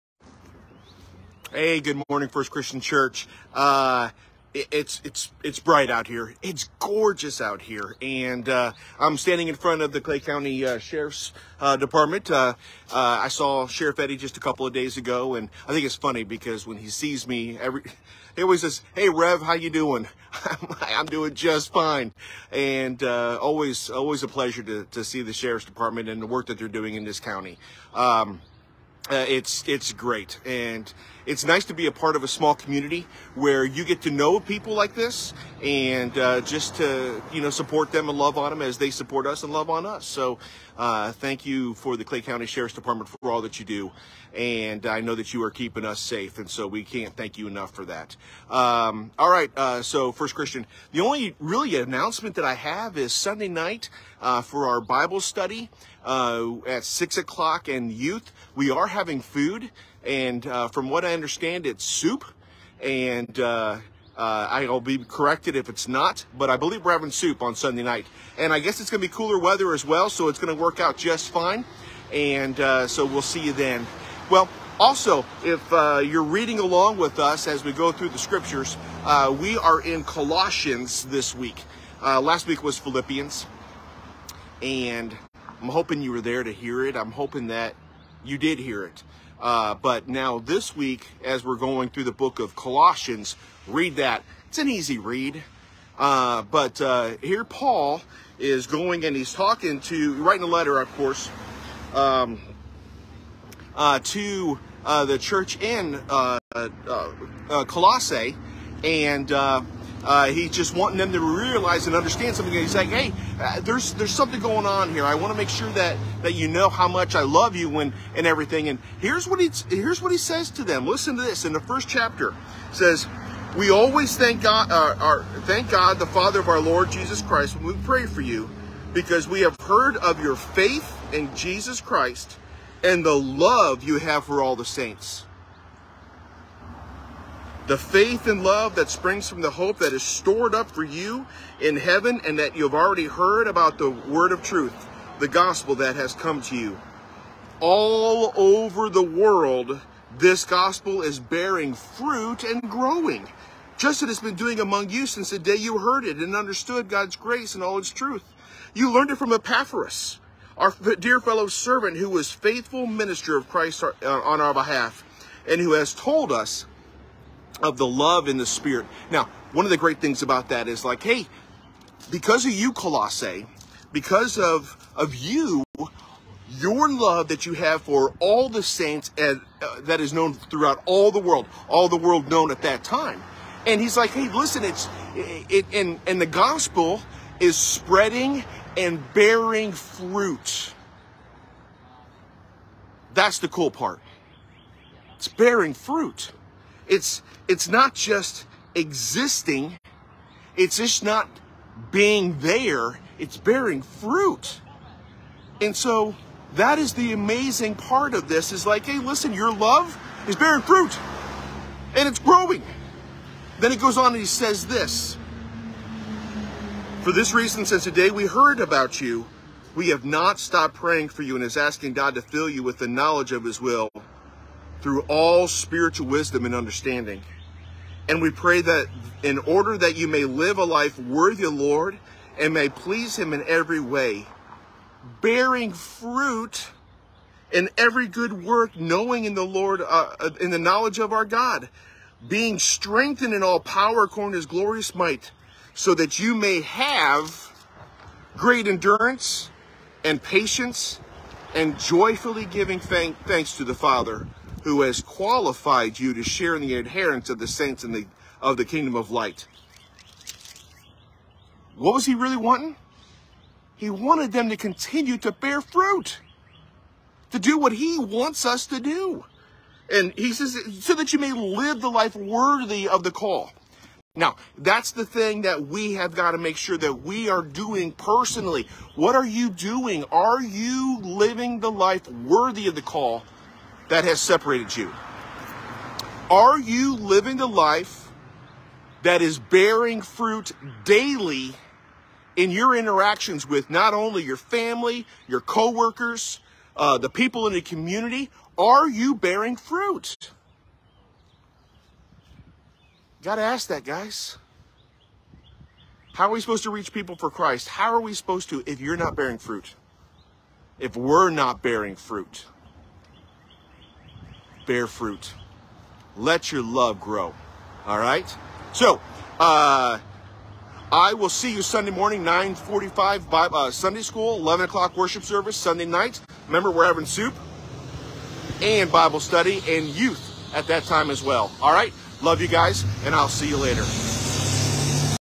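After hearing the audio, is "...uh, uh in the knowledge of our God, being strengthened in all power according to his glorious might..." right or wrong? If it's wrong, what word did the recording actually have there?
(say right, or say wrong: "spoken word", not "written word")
right.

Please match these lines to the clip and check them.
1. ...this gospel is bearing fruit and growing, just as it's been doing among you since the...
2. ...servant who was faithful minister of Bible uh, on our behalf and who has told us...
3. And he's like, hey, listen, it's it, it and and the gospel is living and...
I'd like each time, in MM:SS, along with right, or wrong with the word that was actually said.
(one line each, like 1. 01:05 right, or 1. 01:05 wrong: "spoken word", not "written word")
1. 02:30 right
2. 02:41 wrong: "Christ", not "Bible"
3. 03:03 wrong: "spreading", not "living".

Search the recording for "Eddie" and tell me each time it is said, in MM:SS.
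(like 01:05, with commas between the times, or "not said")
00:13.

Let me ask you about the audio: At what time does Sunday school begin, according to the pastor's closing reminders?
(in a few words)
9:45.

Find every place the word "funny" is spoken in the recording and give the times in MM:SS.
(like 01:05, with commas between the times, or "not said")
00:15.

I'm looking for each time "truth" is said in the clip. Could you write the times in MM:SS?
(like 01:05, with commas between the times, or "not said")
02:24, 02:37.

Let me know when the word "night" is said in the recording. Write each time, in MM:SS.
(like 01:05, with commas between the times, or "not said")
00:53, 01:07, 05:25.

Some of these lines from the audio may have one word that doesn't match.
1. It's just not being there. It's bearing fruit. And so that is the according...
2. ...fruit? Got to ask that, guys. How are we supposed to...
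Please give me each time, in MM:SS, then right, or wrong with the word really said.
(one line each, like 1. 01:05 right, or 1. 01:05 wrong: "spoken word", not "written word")
1. 03:20 wrong: "amazing", not "according"
2. 04:59 right.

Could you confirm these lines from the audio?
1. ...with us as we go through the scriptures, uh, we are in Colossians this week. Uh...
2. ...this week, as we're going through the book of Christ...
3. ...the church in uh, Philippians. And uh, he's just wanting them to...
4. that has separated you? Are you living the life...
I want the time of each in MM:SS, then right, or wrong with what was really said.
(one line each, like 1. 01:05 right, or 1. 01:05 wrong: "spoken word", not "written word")
1. 01:16 right
2. 01:30 wrong: "Colossians", not "Christ"
3. 01:45 wrong: "Colossae", not "Philippians"
4. 04:43 right.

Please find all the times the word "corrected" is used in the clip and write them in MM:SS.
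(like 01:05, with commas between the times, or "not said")
01:04.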